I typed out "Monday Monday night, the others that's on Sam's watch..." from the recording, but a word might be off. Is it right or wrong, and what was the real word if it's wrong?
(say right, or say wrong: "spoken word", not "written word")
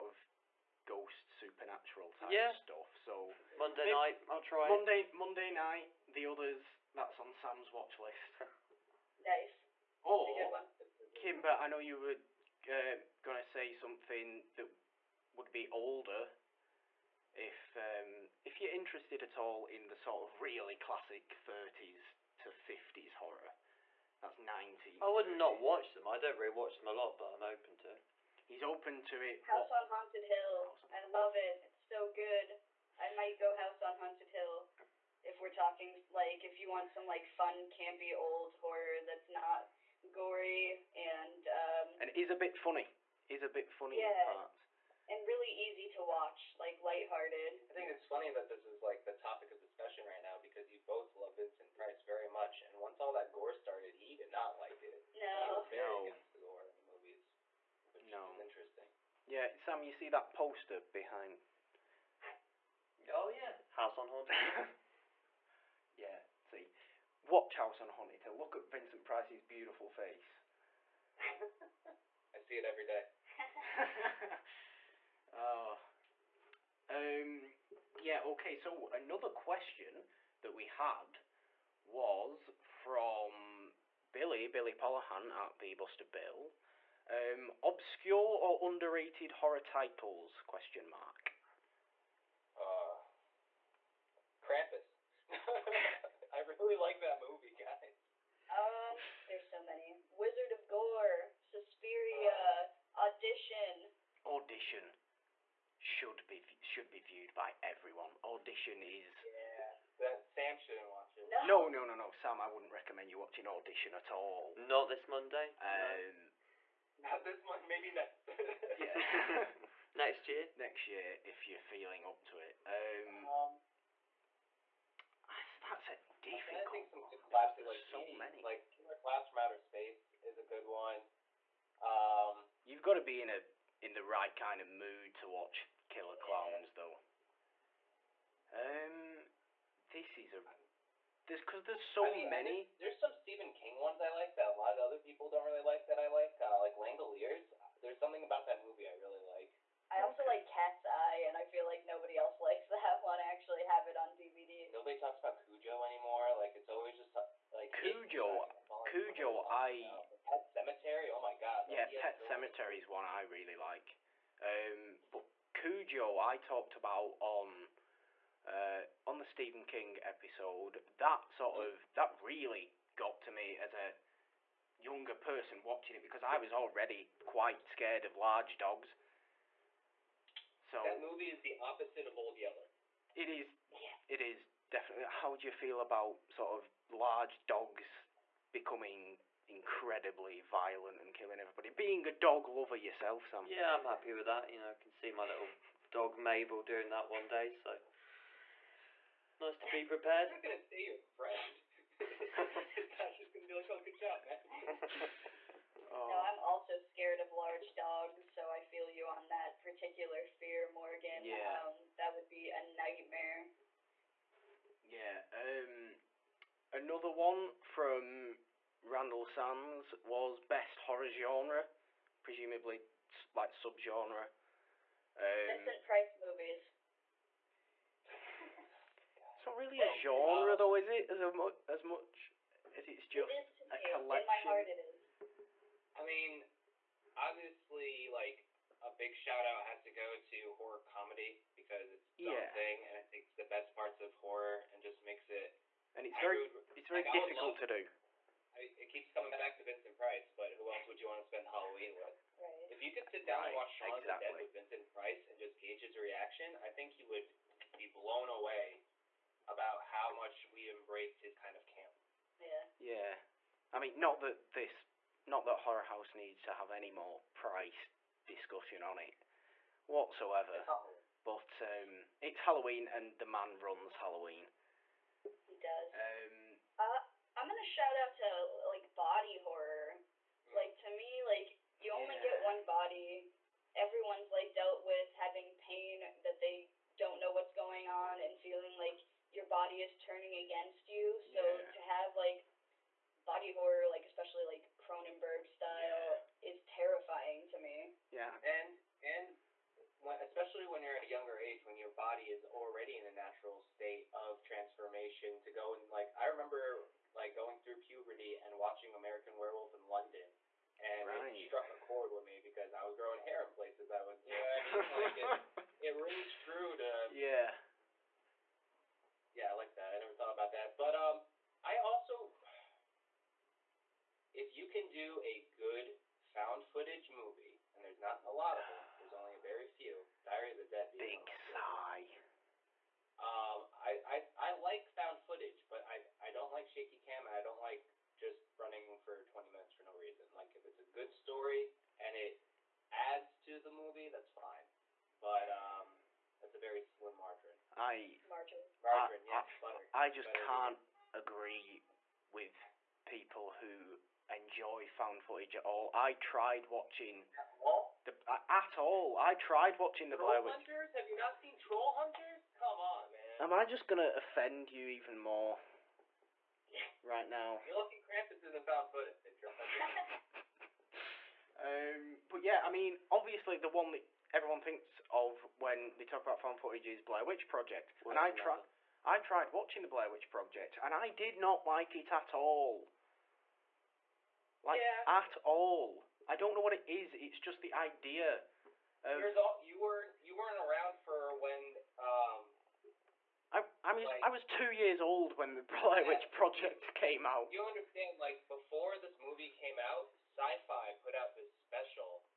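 right.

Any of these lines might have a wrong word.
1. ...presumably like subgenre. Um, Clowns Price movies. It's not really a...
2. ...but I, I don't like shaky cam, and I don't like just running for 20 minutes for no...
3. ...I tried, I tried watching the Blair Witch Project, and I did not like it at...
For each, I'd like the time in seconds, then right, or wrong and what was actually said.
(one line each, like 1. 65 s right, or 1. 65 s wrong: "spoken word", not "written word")
1. 222 s wrong: "Vincent", not "Clowns"
2. 335 s right
3. 378 s right.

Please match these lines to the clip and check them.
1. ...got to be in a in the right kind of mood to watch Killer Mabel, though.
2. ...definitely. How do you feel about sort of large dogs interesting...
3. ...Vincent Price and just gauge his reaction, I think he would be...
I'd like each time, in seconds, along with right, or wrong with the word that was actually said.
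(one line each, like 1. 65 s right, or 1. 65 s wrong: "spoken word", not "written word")
1. 132 s wrong: "Clowns", not "Mabel"
2. 184 s wrong: "becoming", not "interesting"
3. 254 s right.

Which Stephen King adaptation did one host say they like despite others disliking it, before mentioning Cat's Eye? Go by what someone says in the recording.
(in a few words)
Langoliers.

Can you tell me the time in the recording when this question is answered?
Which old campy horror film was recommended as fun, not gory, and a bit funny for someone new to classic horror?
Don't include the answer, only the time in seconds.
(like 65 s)
33 s.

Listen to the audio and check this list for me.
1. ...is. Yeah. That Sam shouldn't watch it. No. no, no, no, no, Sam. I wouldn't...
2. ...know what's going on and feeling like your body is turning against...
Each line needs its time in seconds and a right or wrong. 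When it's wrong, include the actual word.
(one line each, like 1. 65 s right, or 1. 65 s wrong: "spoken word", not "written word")
1. 108 s right
2. 287 s right.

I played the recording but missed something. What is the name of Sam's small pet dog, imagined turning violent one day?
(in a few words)
Mabel.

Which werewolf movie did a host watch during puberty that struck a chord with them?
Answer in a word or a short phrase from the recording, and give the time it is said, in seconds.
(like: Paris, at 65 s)
American Werewolf in London, at 308 s.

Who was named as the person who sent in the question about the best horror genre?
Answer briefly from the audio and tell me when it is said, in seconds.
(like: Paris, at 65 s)
Randall Sands, at 218 s.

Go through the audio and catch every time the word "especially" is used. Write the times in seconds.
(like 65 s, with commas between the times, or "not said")
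294 s, 300 s.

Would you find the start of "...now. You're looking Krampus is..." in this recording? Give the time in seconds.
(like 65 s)
367 s.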